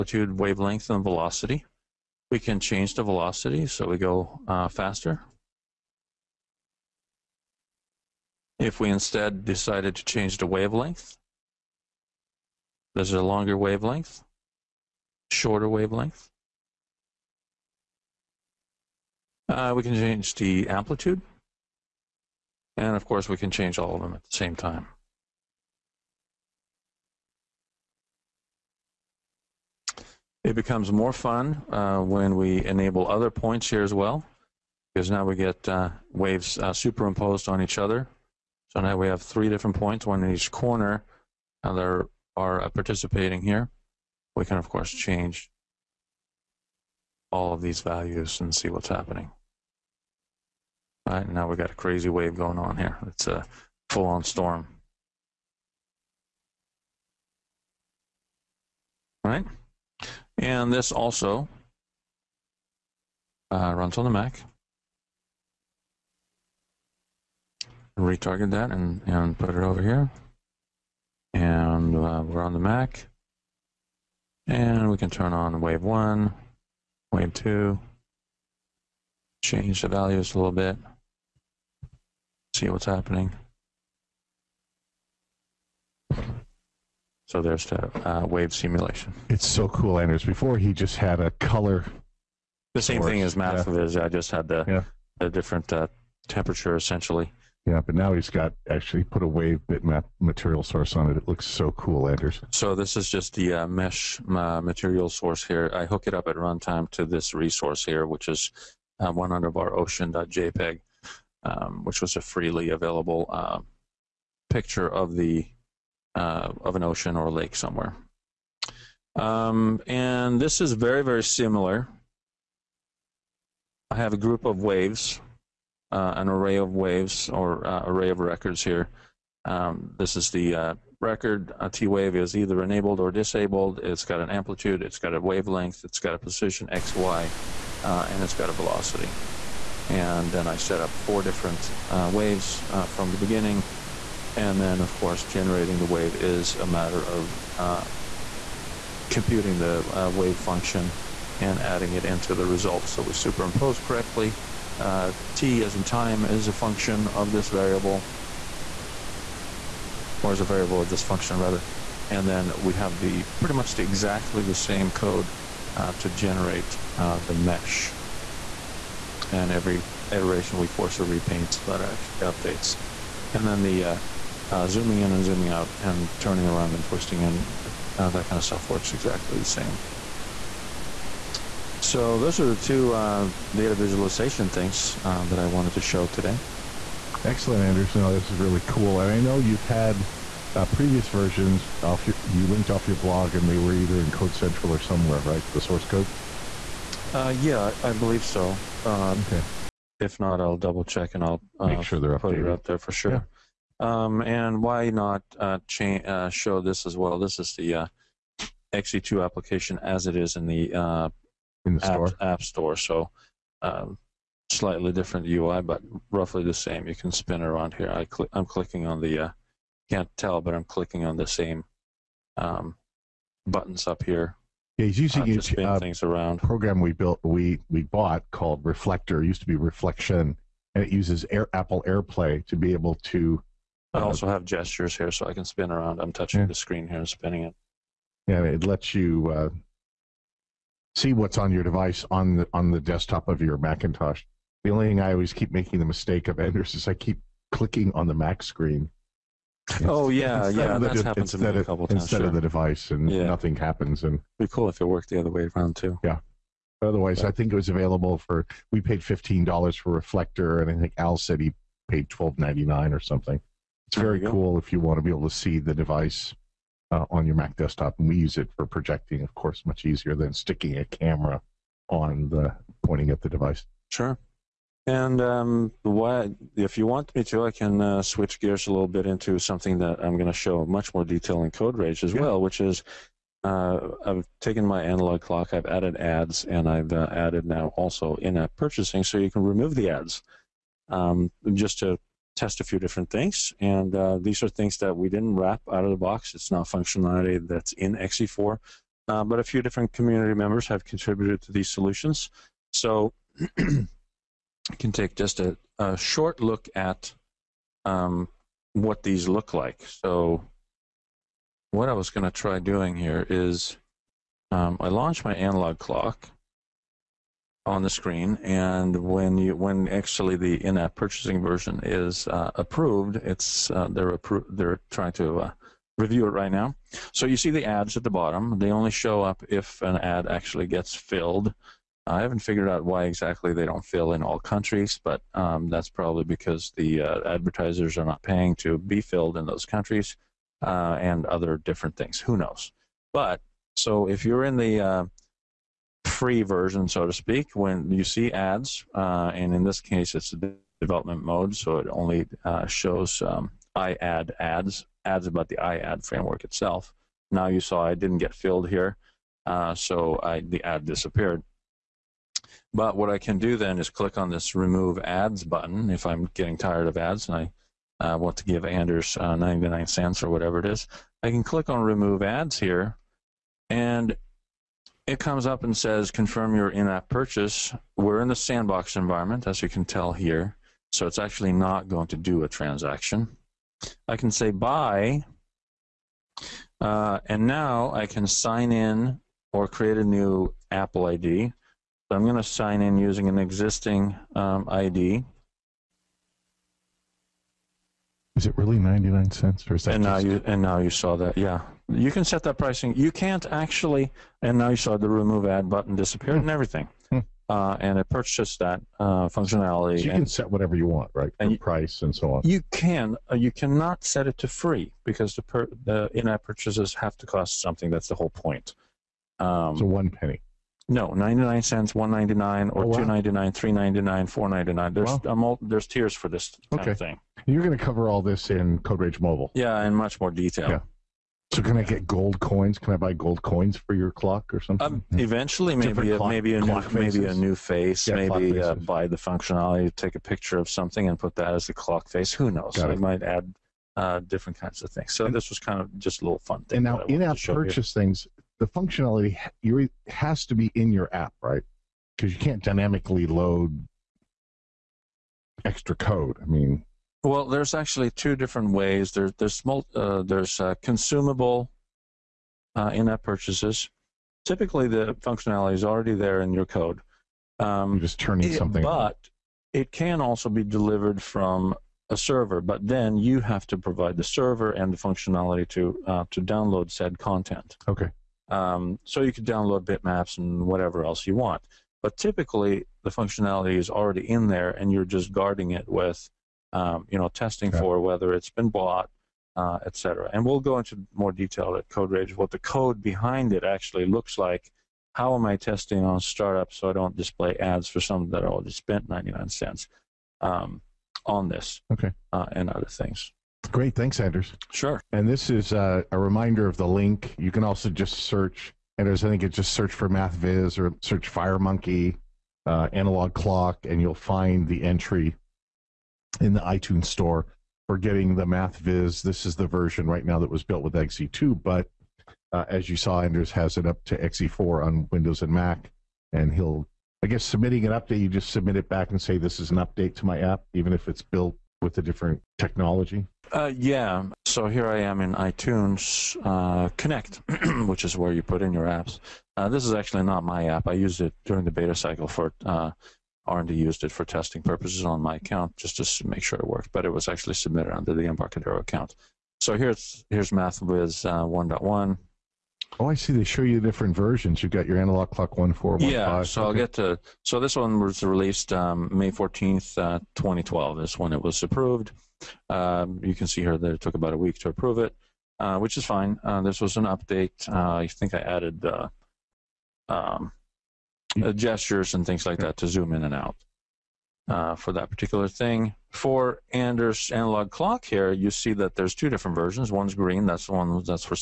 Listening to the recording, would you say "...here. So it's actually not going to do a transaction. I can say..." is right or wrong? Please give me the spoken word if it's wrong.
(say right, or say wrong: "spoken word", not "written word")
right.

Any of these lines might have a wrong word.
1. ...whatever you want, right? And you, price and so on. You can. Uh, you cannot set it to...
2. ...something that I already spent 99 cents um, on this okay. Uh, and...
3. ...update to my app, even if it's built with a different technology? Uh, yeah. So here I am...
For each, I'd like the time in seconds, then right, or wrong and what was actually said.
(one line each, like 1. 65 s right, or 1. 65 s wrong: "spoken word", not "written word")
1. 410 s right
2. 497 s right
3. 529 s right.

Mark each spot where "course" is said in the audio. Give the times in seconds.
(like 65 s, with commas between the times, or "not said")
23 s, 44 s, 144 s, 269 s.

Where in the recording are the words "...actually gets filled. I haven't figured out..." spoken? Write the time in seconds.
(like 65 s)
330 s.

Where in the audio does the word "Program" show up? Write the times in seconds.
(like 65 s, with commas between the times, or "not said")
226 s.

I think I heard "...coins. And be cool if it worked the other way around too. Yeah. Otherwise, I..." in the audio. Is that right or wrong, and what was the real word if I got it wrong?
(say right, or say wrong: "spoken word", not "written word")
wrong: "happens", not "coins".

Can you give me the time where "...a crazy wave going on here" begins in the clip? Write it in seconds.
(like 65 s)
51 s.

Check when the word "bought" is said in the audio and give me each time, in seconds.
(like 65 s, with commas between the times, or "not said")
227 s, 488 s.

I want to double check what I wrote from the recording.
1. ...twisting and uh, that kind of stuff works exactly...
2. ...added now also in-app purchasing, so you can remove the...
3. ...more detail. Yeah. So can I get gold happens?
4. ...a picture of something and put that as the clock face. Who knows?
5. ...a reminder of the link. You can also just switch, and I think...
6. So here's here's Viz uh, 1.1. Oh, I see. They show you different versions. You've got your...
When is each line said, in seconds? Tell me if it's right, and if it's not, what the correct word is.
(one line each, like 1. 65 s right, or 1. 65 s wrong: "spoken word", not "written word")
1. 176 s right
2. 287 s right
3. 430 s wrong: "coins", not "happens"
4. 440 s right
5. 506 s wrong: "search", not "switch"
6. 549 s wrong: "MathViz", not "Viz".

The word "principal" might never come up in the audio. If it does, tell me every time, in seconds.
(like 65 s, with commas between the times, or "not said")
not said.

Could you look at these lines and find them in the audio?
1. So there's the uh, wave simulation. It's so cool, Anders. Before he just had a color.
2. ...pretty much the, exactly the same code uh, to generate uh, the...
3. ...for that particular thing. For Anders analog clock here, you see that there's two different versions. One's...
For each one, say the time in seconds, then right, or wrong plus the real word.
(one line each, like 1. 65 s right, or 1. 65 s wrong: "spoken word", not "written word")
1. 87 s right
2. 163 s right
3. 574 s right.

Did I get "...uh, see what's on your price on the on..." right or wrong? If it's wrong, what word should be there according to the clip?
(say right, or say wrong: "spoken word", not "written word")
wrong: "device", not "price".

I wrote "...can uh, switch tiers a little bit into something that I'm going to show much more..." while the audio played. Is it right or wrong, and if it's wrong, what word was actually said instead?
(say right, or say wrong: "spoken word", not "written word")
wrong: "gears", not "tiers".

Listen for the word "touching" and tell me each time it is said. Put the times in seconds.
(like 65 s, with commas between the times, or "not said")
236 s.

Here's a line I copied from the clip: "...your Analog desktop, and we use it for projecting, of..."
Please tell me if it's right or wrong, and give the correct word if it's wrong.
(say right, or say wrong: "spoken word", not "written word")
wrong: "Mac", not "Analog".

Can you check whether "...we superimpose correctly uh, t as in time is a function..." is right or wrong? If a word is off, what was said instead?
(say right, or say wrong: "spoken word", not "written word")
right.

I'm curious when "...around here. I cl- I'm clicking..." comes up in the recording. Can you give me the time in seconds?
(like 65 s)
217 s.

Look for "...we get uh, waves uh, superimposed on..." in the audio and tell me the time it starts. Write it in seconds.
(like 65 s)
35 s.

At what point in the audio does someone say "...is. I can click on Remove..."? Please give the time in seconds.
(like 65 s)
370 s.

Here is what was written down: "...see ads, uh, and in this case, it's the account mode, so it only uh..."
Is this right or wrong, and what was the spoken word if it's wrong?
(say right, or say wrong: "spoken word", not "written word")
wrong: "development", not "account".